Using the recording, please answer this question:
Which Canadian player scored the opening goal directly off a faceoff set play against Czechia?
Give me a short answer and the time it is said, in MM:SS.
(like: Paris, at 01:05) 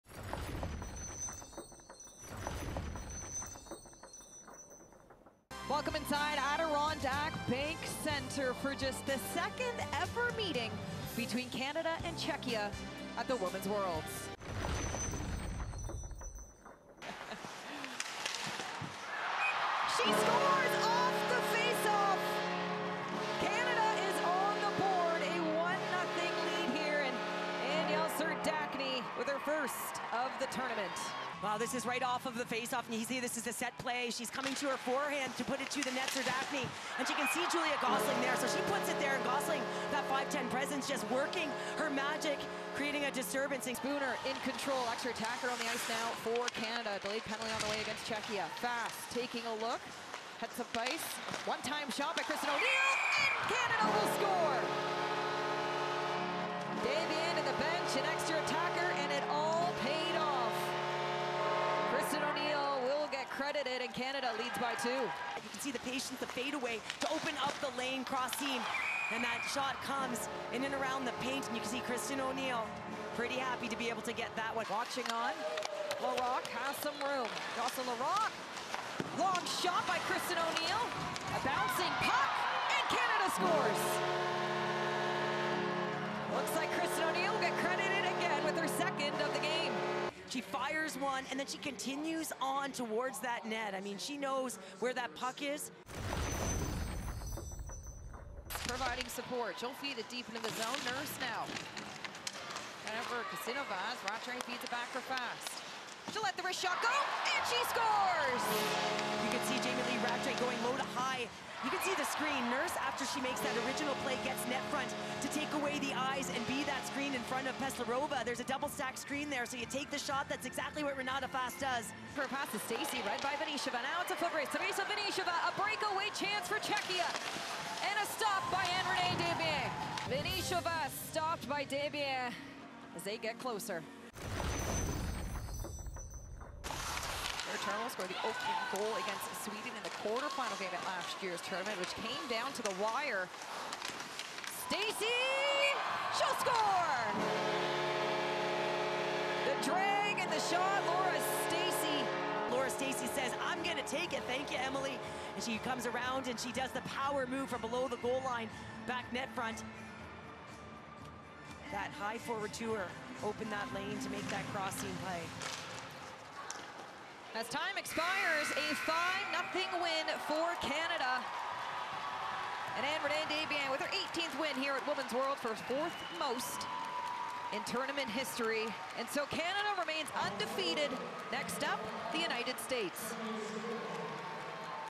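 Danielle Serdachny, at 00:27.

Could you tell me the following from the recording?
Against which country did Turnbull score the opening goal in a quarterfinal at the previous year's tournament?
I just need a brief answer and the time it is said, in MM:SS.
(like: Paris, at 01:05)
Sweden, at 02:19.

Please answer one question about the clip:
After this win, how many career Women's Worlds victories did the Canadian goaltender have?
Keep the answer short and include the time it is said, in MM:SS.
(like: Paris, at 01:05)
18, at 02:53.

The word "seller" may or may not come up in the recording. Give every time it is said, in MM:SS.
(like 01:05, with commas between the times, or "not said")
not said.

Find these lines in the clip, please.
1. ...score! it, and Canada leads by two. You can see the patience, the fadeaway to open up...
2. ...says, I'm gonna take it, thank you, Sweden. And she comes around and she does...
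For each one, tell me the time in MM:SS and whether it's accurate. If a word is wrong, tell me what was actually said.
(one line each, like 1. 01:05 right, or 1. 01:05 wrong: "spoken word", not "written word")
1. 00:54 right
2. 02:33 wrong: "Emily", not "Sweden".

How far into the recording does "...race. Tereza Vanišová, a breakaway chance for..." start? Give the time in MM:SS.
02:04.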